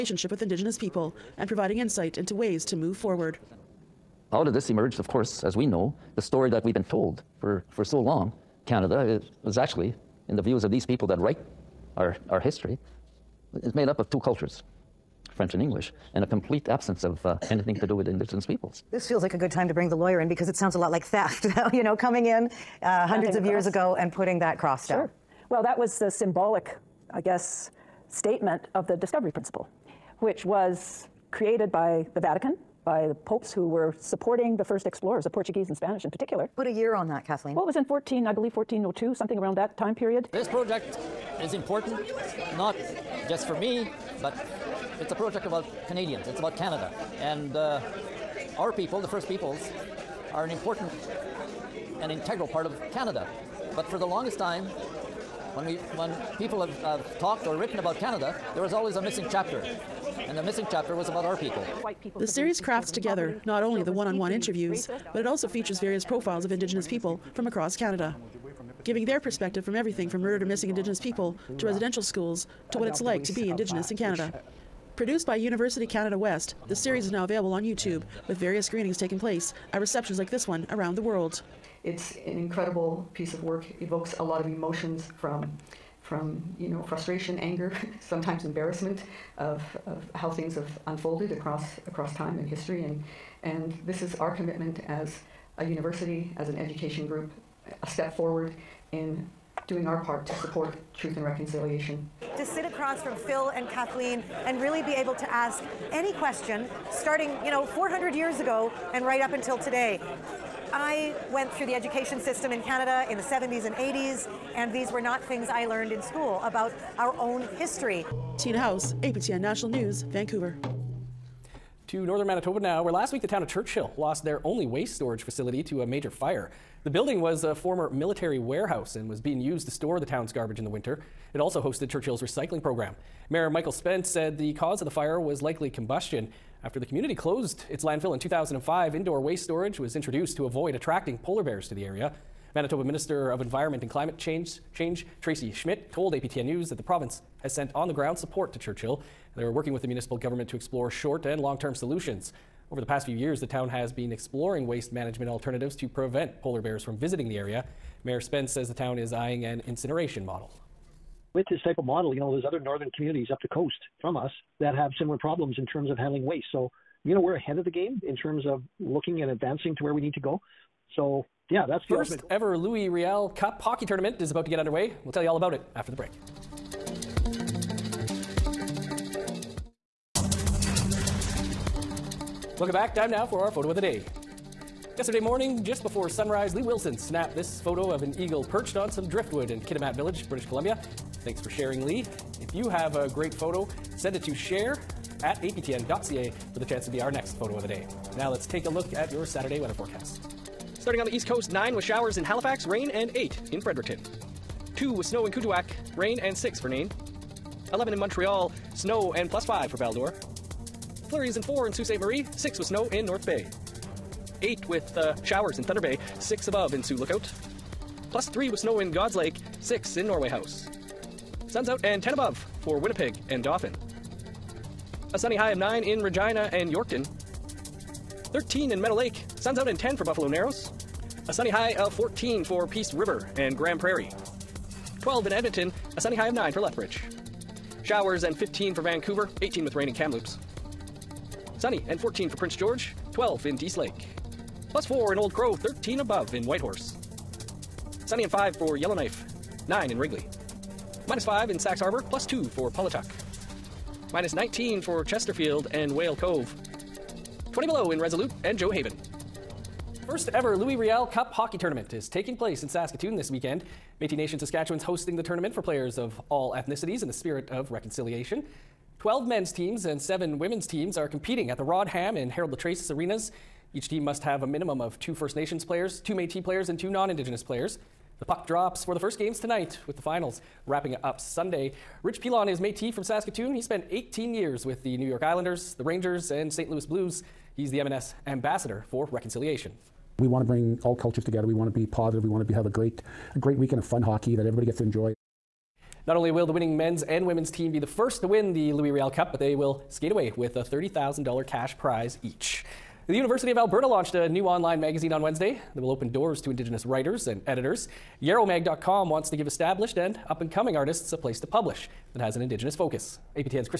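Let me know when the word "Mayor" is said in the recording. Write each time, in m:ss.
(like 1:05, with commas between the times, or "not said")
2:13, 2:38.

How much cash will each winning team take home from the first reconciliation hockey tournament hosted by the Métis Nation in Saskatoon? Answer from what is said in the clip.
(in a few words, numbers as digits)
$30,000.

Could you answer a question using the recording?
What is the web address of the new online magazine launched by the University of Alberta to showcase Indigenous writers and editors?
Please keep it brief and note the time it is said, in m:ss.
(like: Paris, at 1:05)
Yarrowmag.com, at 5:08.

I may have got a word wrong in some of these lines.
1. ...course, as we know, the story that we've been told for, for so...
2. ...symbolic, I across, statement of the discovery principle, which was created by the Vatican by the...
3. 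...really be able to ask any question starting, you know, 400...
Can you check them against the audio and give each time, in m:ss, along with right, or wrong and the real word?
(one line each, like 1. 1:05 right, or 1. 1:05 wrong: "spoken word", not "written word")
1. 0:05 right
2. 0:26 wrong: "guess", not "across"
3. 1:44 right.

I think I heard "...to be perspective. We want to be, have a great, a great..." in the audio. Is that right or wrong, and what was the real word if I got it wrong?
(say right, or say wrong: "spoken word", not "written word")
wrong: "positive", not "perspective".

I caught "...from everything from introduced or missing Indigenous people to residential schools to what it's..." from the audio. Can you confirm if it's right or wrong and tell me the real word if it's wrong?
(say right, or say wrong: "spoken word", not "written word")
wrong: "murdered", not "introduced".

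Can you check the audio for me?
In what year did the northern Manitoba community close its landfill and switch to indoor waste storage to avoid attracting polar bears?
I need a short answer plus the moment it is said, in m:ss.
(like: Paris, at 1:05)
2005, at 2:18.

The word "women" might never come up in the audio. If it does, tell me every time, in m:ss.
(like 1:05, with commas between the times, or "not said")
4:30, 4:57.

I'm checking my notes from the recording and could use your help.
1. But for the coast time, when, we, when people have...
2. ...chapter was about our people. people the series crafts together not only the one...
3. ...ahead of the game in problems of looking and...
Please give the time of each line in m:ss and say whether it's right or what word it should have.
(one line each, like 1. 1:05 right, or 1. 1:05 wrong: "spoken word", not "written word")
1. 0:53 wrong: "longest", not "coast"
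2. 1:00 right
3. 2:47 wrong: "terms", not "problems".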